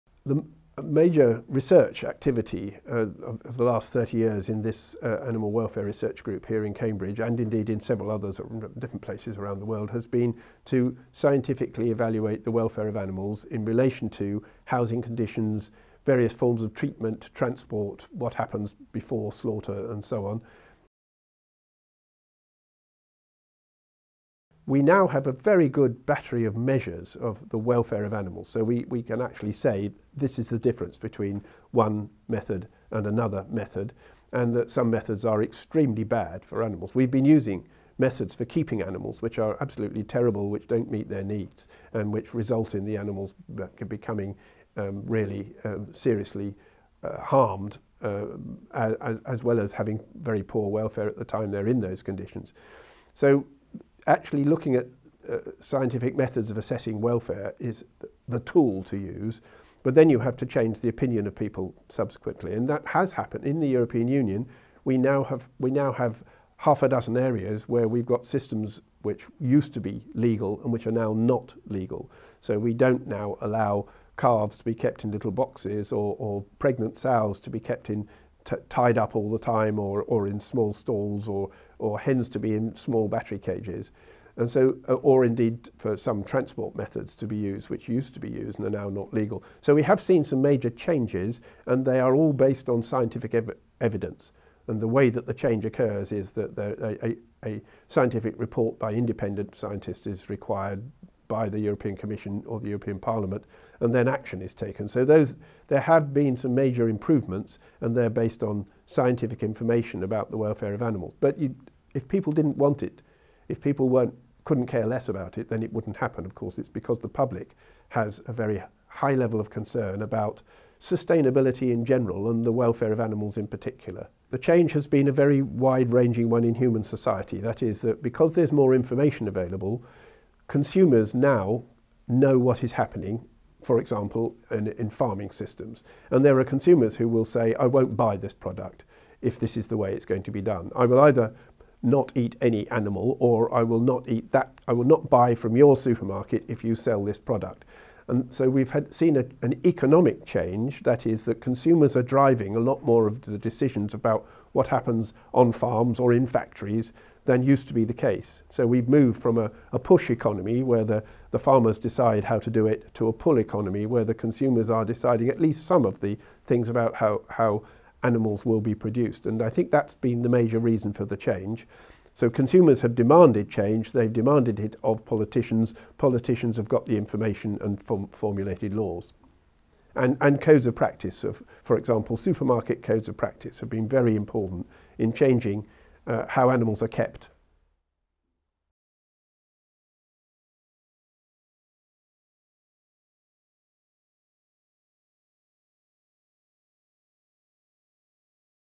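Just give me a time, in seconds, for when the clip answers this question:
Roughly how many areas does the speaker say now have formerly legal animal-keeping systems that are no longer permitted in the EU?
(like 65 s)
66 s.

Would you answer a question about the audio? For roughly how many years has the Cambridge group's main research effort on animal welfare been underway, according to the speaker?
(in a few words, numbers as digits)
30 years.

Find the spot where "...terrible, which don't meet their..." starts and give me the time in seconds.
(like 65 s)
40 s.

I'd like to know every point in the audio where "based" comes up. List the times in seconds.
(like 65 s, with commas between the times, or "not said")
92 s, 108 s.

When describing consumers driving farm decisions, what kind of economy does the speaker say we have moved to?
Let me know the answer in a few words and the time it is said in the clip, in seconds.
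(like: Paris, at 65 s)
pull economy, at 163 s.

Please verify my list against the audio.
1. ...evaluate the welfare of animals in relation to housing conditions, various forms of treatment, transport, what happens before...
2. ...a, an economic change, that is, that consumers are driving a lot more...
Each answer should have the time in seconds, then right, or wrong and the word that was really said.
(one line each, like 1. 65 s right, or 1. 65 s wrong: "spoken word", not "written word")
1. 11 s right
2. 149 s right.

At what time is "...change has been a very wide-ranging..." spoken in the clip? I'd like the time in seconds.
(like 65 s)
124 s.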